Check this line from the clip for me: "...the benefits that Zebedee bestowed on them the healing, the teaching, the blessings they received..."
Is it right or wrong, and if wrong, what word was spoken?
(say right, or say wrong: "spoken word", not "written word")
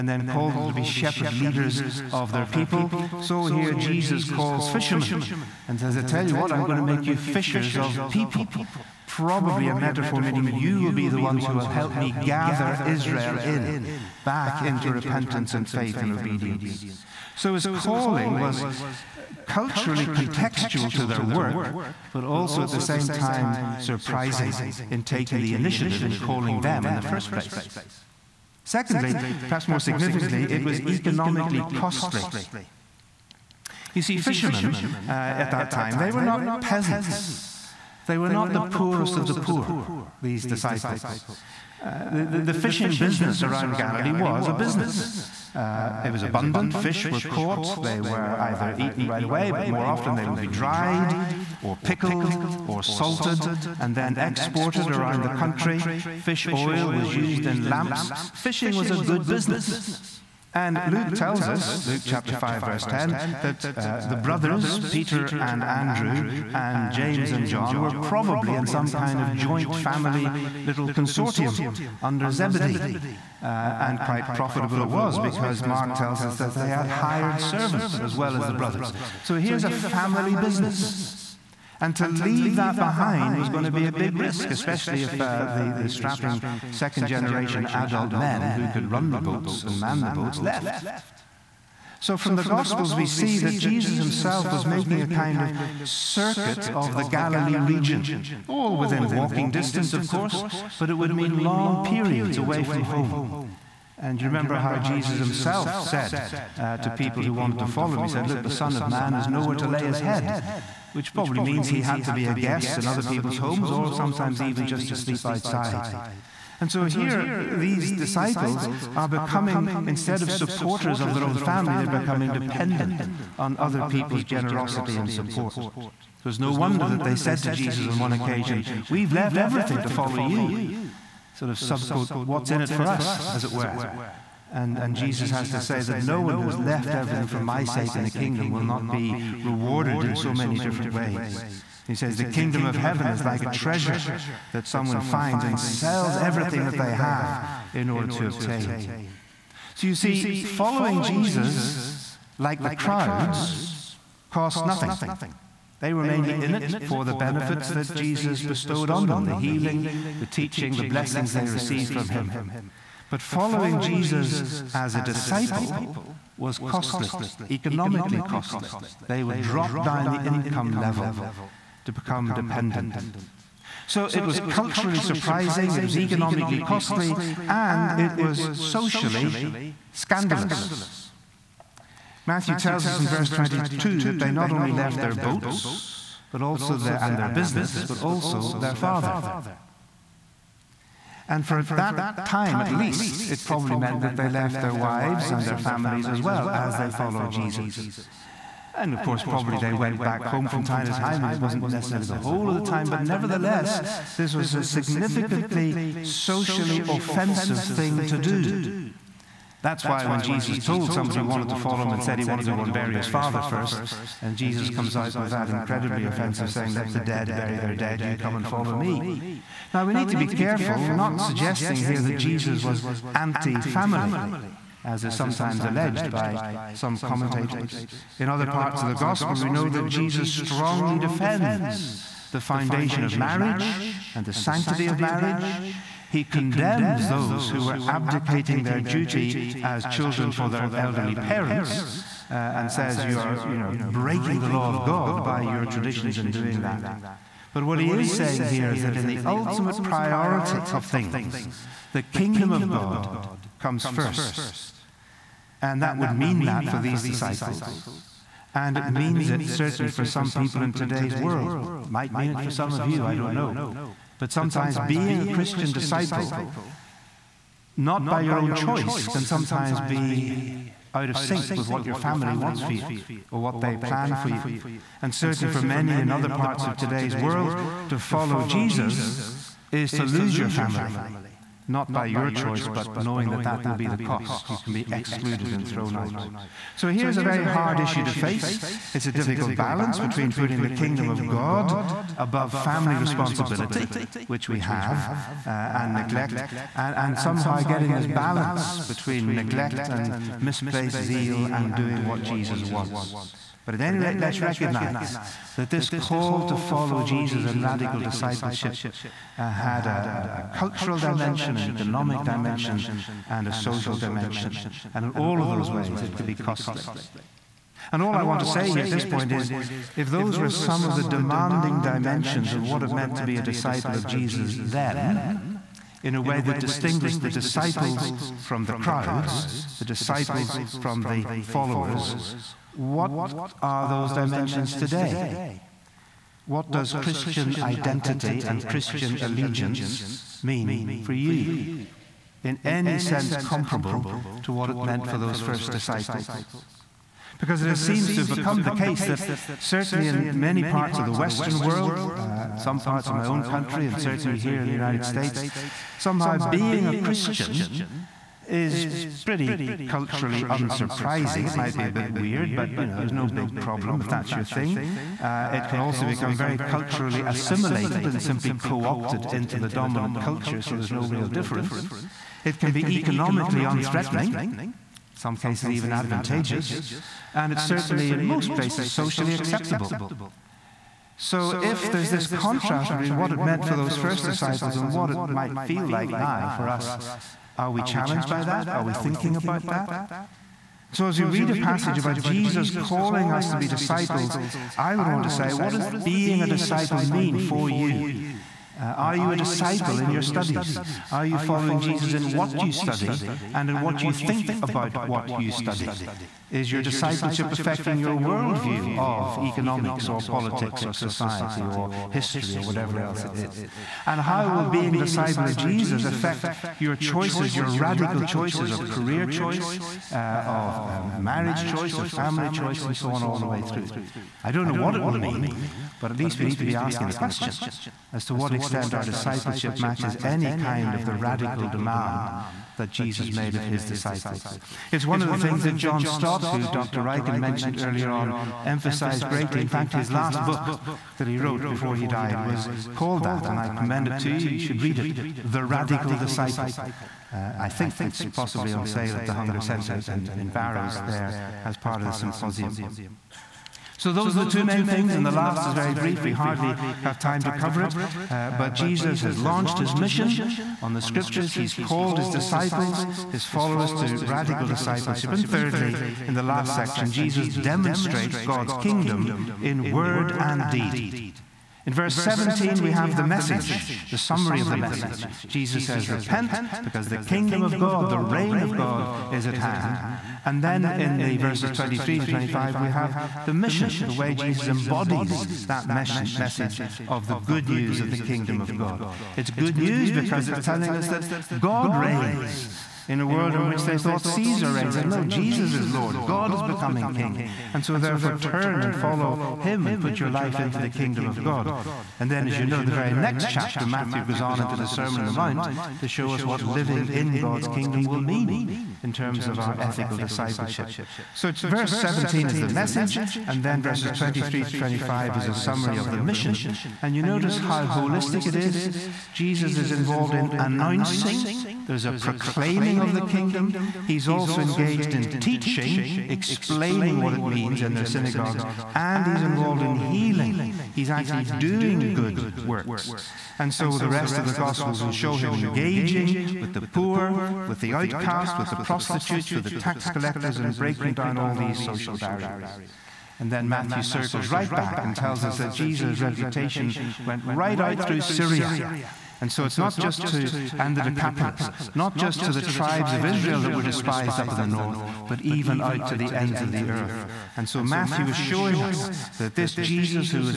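wrong: "Jesus", not "Zebedee".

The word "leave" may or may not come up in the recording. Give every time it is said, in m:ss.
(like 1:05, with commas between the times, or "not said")
1:22.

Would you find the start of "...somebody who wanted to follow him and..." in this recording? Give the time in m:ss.
3:30.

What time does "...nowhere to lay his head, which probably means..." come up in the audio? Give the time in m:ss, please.
1:49.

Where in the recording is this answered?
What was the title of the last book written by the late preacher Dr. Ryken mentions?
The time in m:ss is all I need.
7:25.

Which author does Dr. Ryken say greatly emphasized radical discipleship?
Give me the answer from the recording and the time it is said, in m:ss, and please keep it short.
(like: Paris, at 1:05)
John Stott, at 7:15.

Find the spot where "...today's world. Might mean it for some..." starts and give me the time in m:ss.
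4:20.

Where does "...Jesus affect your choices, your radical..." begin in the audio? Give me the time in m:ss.
6:55.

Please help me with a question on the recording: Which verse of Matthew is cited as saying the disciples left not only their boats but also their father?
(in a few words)
Verse 22.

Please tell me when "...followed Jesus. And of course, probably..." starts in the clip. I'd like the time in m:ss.
3:16.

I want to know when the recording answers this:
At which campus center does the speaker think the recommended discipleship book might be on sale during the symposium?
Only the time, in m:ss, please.
7:29.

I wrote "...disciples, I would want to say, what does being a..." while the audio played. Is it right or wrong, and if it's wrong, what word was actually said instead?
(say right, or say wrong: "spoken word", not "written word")
right.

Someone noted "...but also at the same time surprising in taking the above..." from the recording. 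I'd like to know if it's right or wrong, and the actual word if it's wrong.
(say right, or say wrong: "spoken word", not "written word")
wrong: "initiative", not "above".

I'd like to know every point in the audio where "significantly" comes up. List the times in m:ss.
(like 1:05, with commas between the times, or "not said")
0:29, 3:24.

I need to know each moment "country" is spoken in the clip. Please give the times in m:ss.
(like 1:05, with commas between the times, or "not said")
0:55, 5:53.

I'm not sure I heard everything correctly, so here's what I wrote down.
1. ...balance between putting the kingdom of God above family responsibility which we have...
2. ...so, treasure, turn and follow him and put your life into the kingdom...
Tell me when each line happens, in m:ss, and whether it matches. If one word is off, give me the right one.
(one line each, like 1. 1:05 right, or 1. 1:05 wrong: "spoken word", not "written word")
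1. 4:49 right
2. 8:17 wrong: "therefore", not "treasure".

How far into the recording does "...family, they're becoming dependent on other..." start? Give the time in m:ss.
2:01.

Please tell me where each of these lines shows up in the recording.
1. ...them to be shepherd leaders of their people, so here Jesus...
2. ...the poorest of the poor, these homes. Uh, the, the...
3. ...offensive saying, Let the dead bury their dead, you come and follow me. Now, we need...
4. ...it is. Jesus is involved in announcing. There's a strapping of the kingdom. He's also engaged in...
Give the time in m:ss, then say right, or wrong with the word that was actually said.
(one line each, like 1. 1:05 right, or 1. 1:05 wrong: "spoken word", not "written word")
1. 0:00 right
2. 0:38 wrong: "disciples", not "homes"
3. 3:36 right
4. 8:38 wrong: "proclaiming", not "strapping".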